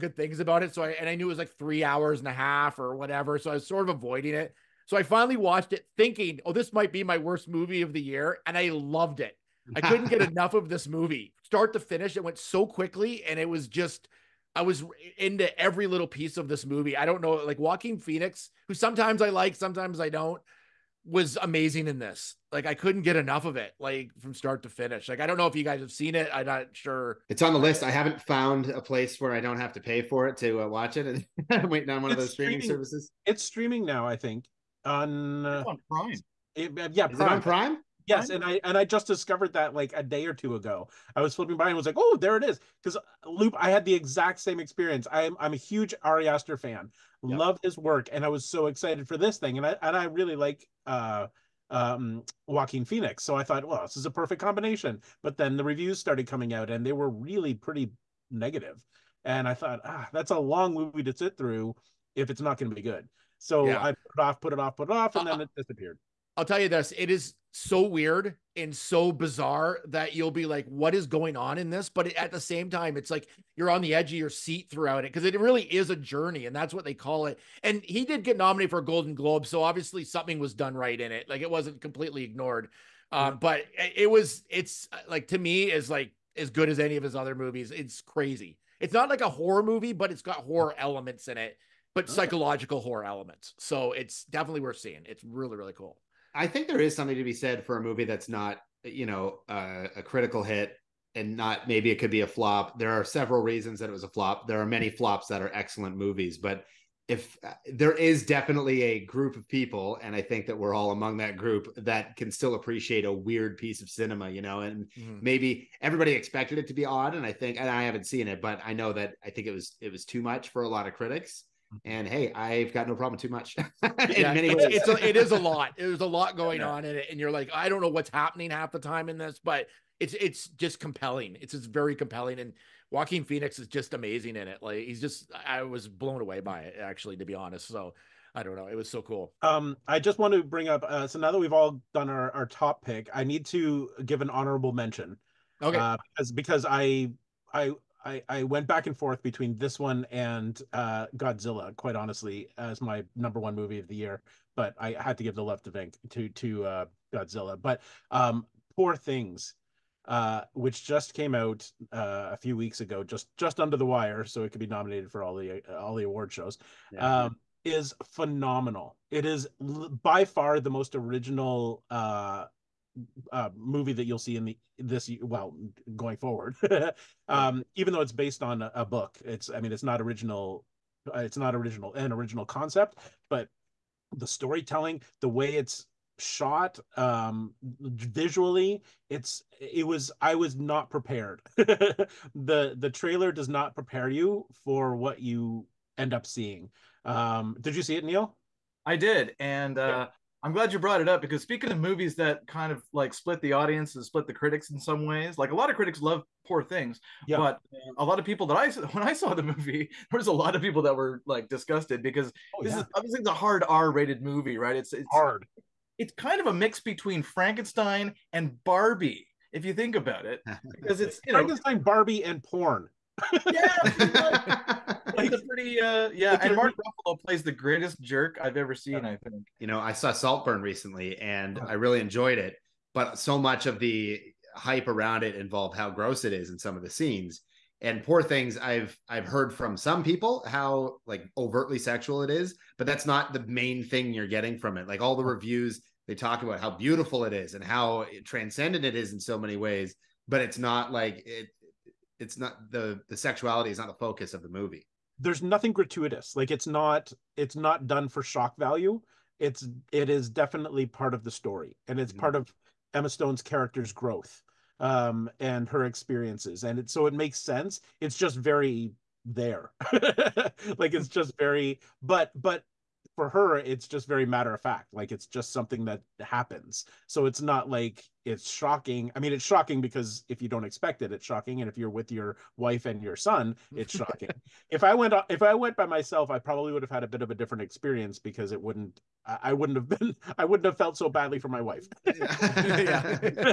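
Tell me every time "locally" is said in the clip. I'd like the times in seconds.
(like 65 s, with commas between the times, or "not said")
not said.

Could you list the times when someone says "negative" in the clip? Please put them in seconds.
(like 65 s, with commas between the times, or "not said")
58 s.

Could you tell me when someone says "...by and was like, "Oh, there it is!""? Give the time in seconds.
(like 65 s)
41 s.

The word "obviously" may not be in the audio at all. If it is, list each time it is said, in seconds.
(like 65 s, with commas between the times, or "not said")
79 s, 212 s.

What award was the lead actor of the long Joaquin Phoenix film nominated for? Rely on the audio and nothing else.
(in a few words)
Golden Globe.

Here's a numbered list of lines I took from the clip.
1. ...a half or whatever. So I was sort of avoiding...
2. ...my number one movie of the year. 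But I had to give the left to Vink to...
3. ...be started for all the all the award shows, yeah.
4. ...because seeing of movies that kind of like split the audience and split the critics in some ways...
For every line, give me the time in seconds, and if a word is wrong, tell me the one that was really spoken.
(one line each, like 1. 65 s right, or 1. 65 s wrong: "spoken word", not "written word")
1. 2 s right
2. 152 s right
3. 164 s wrong: "nominated", not "started"
4. 201 s wrong: "speaking", not "seeing".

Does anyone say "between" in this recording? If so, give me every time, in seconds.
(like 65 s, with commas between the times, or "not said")
149 s, 216 s.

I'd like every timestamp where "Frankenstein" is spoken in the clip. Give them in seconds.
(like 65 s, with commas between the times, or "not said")
217 s, 221 s.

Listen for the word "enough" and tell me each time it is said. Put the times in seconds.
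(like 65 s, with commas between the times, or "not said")
10 s, 23 s.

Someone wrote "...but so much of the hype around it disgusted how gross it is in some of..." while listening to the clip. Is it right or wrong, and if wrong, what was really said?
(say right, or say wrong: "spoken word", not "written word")
wrong: "involved", not "disgusted".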